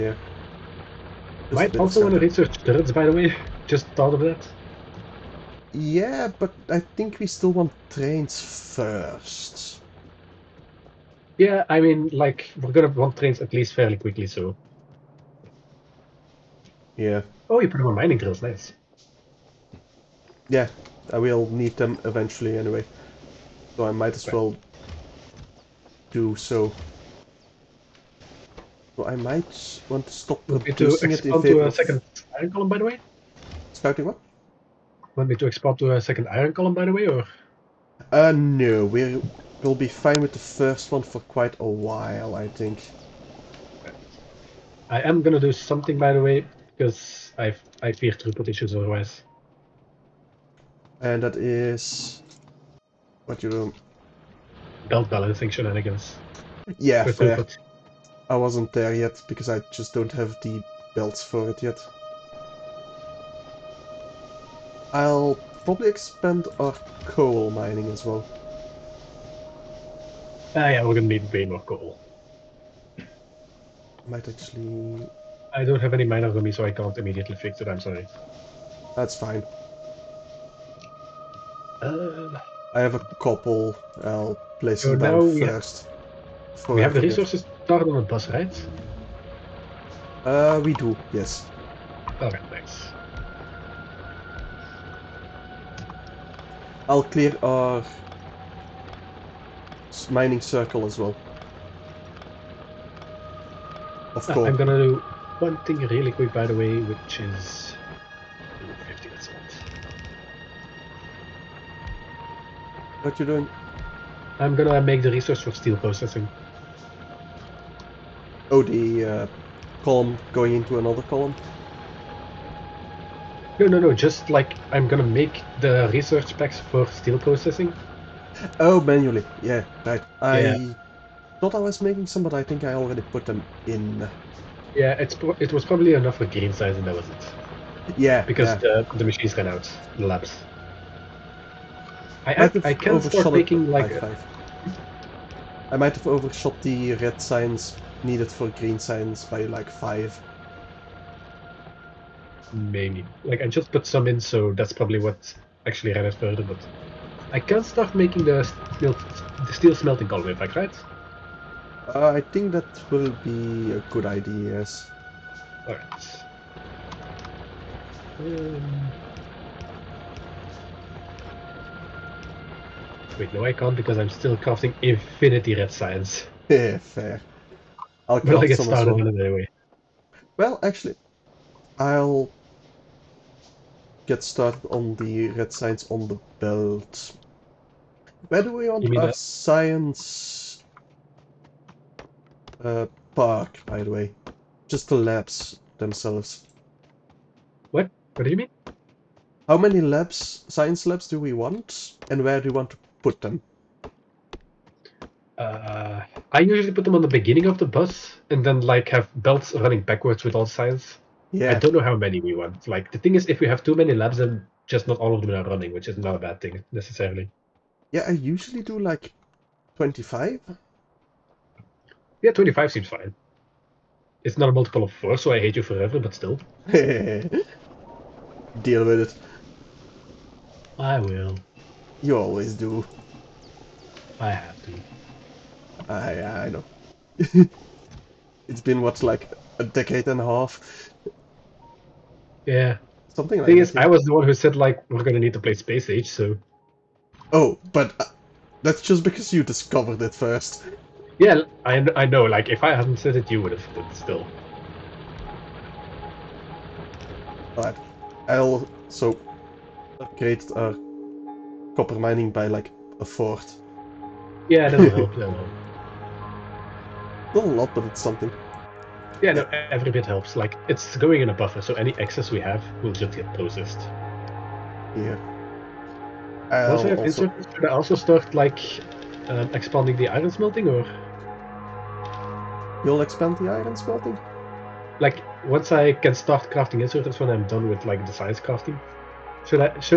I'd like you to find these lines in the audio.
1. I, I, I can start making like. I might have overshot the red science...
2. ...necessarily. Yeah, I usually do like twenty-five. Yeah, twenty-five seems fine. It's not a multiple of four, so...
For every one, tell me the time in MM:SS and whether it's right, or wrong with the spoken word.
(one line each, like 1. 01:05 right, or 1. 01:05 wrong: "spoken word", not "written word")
1. 02:22 right
2. 03:36 right.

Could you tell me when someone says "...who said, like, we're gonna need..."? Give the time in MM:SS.
04:04.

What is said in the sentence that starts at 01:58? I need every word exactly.
Oh, the uh, column going into another column?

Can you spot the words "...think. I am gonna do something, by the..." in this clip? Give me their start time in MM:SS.
00:42.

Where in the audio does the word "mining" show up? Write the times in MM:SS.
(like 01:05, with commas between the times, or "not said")
00:17, 01:07, 01:40, 04:21.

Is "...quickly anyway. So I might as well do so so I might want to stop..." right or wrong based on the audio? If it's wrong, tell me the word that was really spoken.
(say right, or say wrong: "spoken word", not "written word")
wrong: "eventually", not "quickly".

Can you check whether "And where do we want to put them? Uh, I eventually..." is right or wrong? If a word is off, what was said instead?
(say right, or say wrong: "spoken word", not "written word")
wrong: "usually", not "eventually".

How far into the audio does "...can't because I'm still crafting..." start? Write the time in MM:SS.
02:53.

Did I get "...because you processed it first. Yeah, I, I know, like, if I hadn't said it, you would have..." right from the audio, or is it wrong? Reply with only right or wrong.
wrong.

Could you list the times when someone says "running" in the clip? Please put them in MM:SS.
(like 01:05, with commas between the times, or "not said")
03:29, 03:35.